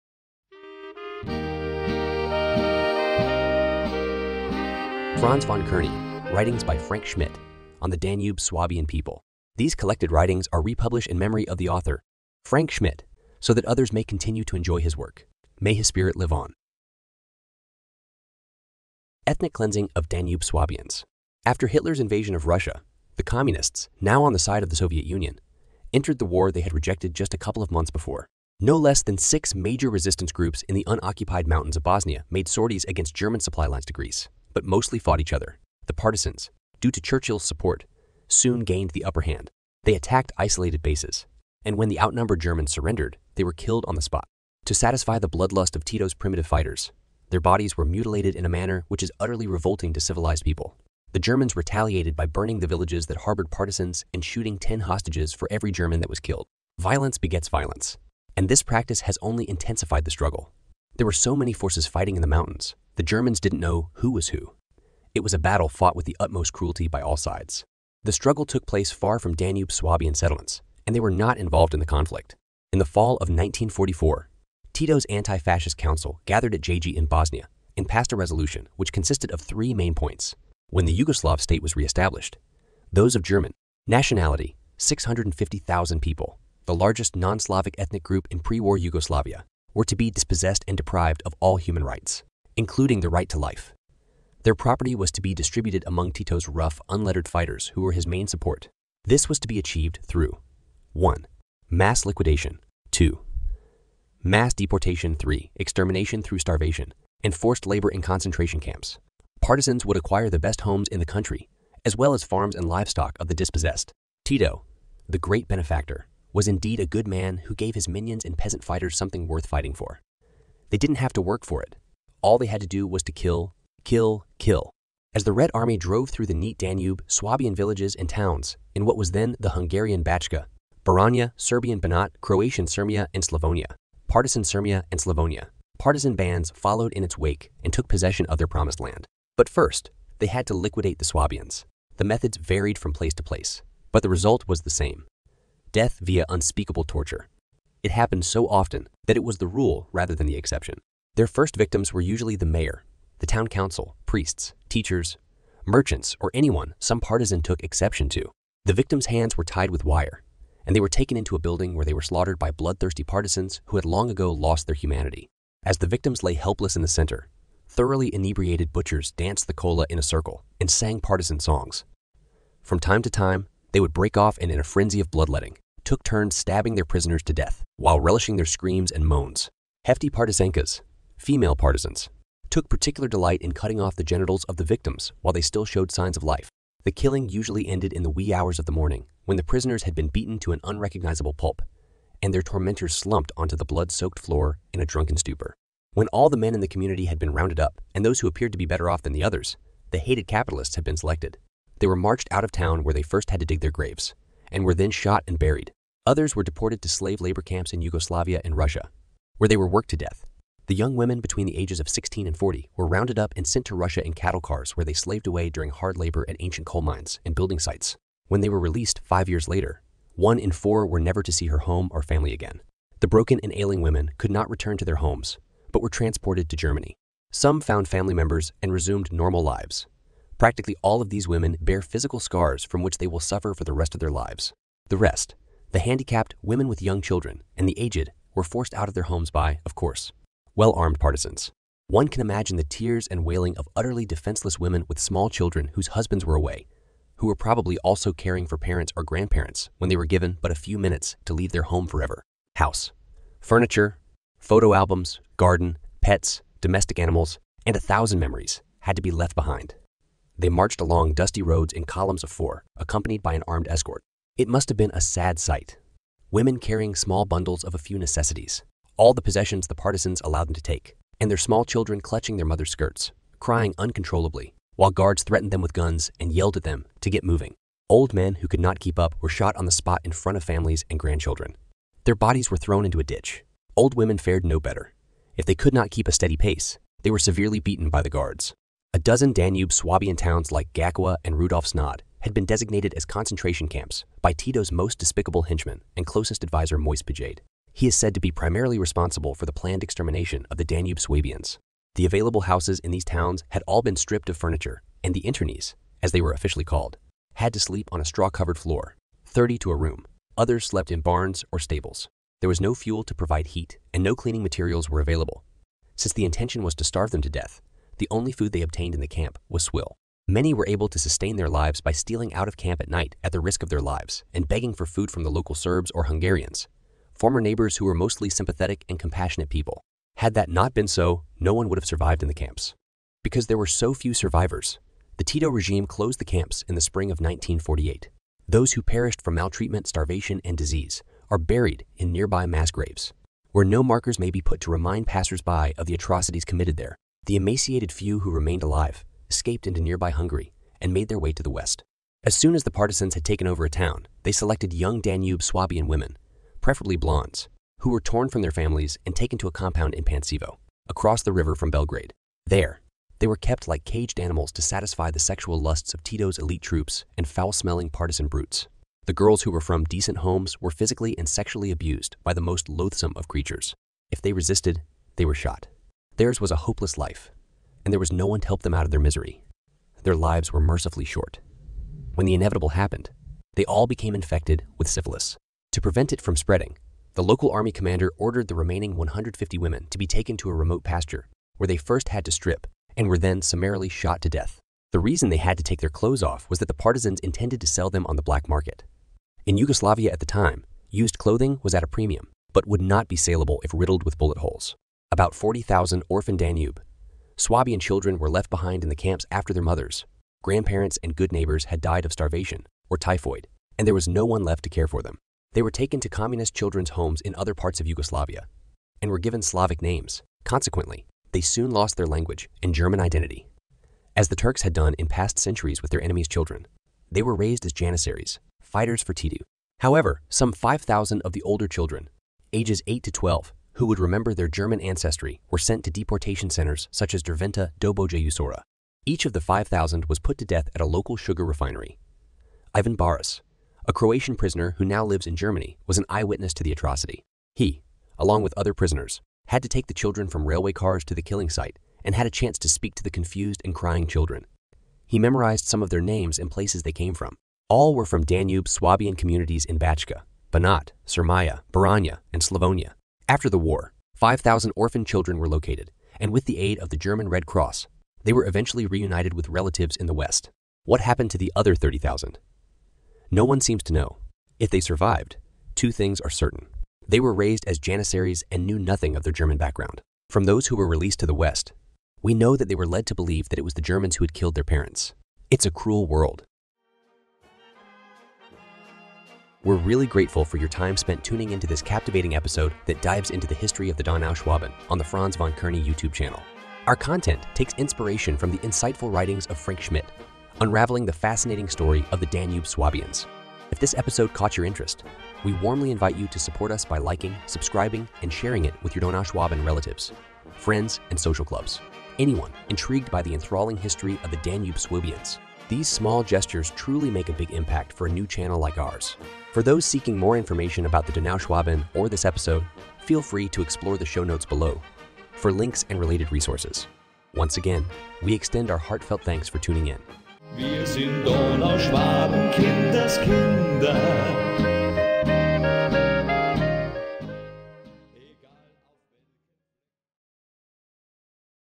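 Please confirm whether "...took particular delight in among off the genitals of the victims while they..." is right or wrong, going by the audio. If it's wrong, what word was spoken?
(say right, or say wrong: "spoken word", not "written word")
wrong: "cutting", not "among".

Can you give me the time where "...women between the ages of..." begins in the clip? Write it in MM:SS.
03:30.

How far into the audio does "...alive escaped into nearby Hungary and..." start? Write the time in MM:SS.
05:48.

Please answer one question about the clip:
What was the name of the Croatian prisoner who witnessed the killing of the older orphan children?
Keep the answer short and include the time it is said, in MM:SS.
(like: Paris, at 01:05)
Ivan Baris, at 07:22.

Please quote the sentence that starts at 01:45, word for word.
Extermination through starvation, and forced labor in concentration camps.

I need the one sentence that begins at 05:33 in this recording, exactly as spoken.
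Because there were so few survivors, the Tito regime closed the camps in the spring of 1948.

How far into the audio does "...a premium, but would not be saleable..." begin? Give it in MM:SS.
06:41.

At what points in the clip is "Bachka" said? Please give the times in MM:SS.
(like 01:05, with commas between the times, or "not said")
02:10, 07:39.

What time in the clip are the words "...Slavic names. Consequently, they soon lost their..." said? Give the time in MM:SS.
06:59.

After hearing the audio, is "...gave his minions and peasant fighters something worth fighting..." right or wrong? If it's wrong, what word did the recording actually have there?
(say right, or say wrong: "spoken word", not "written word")
right.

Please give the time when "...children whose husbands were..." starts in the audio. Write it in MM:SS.
04:05.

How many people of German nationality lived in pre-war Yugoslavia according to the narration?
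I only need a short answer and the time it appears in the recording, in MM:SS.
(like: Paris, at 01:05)
650,000, at 01:24.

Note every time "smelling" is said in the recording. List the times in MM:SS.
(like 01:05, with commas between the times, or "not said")
06:07.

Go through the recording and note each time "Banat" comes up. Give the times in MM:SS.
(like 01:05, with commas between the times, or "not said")
02:11, 07:40.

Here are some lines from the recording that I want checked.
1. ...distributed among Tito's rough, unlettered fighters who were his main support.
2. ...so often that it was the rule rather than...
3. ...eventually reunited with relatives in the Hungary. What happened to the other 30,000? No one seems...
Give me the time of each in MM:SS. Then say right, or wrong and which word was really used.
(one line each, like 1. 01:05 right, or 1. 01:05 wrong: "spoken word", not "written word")
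1. 01:35 right
2. 02:28 right
3. 07:48 wrong: "West", not "Hungary".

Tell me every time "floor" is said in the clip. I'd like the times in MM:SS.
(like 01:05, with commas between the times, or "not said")
03:14, 05:08.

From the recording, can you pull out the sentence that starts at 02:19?
But first, they had to liquidate the Swabians.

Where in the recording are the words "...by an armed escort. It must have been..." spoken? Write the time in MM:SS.
04:23.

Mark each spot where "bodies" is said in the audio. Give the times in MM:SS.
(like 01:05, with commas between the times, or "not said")
00:47, 04:42.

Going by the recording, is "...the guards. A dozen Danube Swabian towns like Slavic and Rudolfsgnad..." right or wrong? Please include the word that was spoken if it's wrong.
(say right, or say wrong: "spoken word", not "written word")
wrong: "Gakowa", not "Slavic".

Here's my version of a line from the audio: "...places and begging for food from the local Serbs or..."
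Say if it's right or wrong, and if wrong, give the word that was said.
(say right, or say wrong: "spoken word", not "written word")
wrong: "lives", not "places".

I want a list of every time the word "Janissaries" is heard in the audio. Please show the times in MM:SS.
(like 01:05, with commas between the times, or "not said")
07:07, 07:57.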